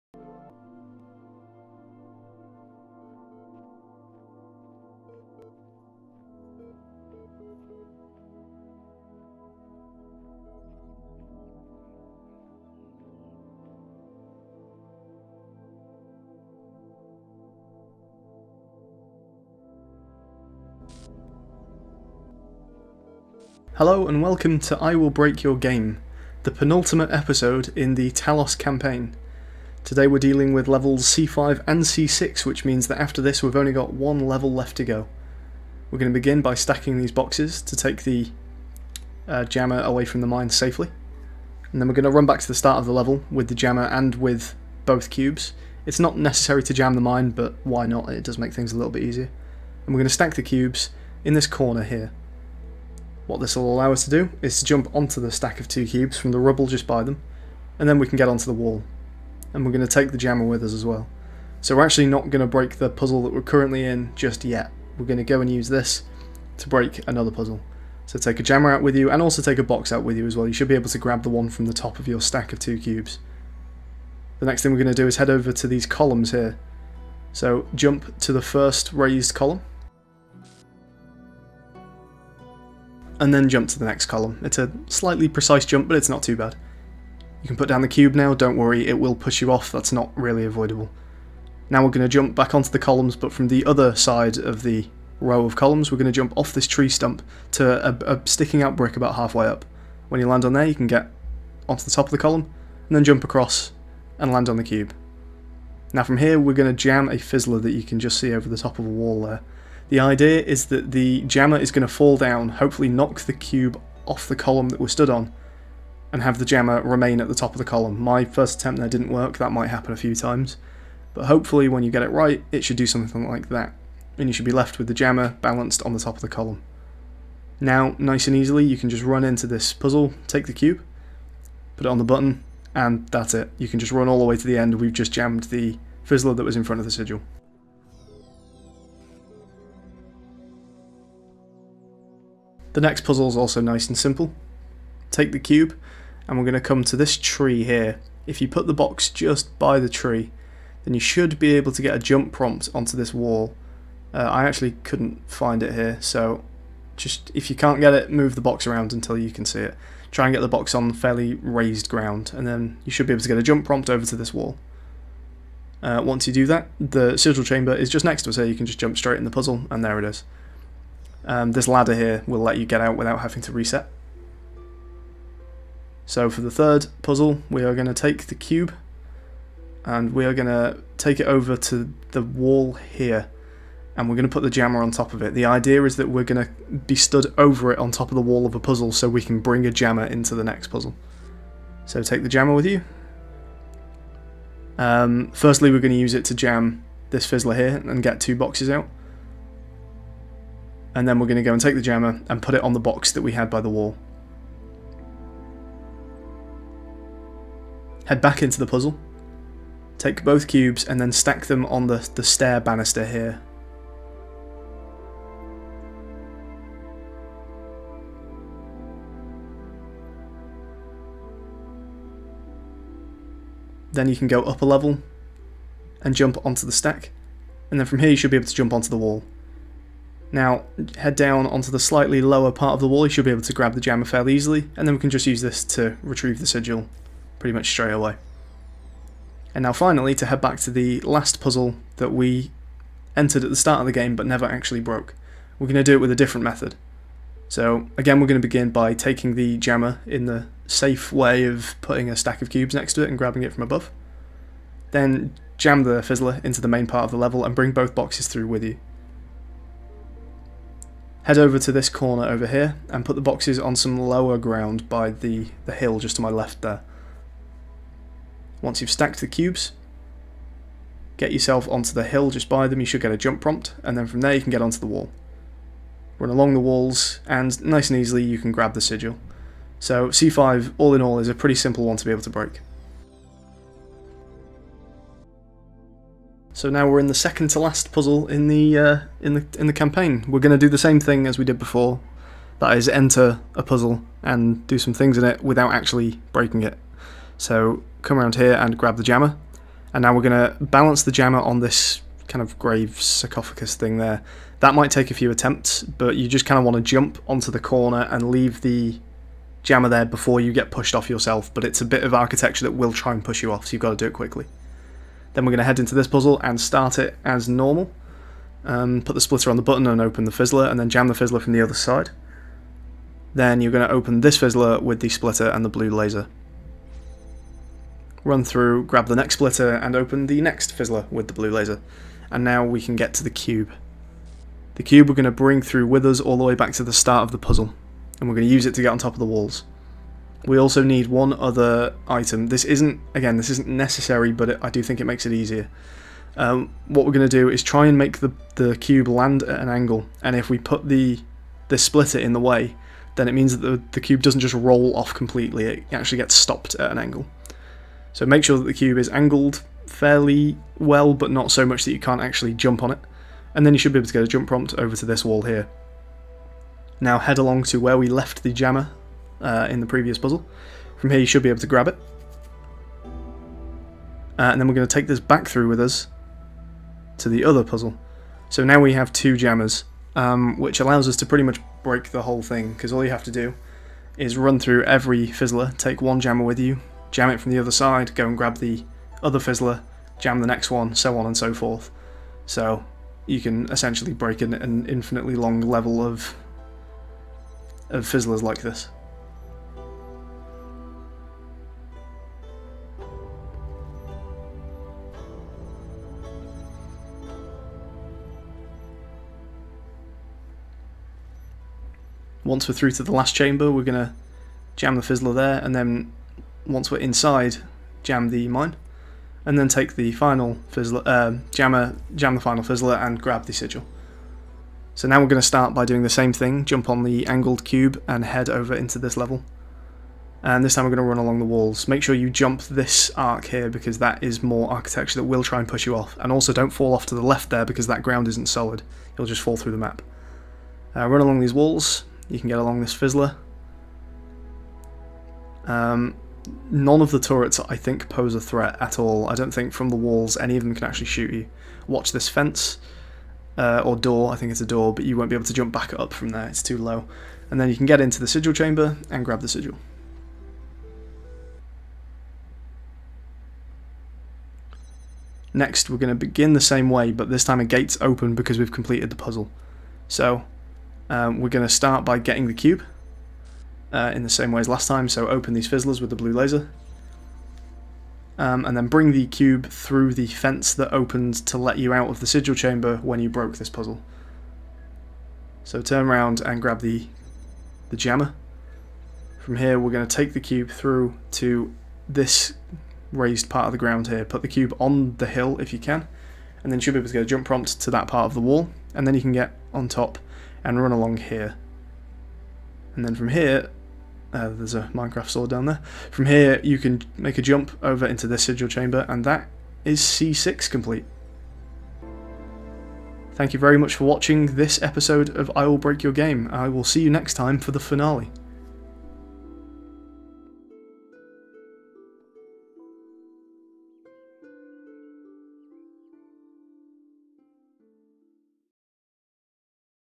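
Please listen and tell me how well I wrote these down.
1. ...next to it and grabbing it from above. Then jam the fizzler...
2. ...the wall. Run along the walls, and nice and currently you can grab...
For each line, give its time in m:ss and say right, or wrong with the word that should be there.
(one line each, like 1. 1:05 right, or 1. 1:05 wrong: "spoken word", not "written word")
1. 4:12 right
2. 4:34 wrong: "easily", not "currently".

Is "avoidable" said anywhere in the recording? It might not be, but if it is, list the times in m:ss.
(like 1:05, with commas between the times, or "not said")
1:30.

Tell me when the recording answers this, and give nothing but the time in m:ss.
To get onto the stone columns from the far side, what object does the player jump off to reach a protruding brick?
1:36.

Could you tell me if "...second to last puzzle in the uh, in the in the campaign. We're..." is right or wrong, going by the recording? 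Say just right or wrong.
right.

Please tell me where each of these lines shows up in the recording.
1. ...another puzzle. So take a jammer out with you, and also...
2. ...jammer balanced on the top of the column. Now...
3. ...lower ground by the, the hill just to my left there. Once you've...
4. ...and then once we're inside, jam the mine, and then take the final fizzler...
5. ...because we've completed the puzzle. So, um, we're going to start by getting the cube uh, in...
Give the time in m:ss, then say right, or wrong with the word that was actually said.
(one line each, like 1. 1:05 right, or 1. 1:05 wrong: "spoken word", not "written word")
1. 1:07 right
2. 2:04 right
3. 4:23 right
4. 6:55 right
5. 7:48 right.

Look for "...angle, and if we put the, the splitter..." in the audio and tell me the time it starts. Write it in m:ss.
5:49.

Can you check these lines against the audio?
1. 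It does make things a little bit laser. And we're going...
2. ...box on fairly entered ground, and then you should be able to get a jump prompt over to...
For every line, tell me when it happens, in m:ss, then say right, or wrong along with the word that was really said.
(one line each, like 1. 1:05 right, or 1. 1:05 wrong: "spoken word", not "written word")
1. 0:48 wrong: "easier", not "laser"
2. 2:40 wrong: "raised", not "entered".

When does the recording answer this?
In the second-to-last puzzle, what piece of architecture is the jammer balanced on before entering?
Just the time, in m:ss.
5:02.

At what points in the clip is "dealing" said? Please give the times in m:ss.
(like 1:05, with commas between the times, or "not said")
0:30.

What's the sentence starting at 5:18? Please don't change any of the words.
Um, put the splitter on the button and open the fizzler, and then jam the fizzler from the other side.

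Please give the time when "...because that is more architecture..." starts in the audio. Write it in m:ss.
7:13.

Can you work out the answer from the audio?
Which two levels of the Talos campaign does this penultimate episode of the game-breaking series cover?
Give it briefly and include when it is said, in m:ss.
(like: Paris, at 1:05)
C5 and C6, at 0:31.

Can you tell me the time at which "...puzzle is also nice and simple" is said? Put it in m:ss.
2:23.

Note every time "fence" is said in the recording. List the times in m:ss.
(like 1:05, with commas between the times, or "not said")
7:32, 8:00.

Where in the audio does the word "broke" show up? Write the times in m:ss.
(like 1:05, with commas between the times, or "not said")
4:04, 8:03.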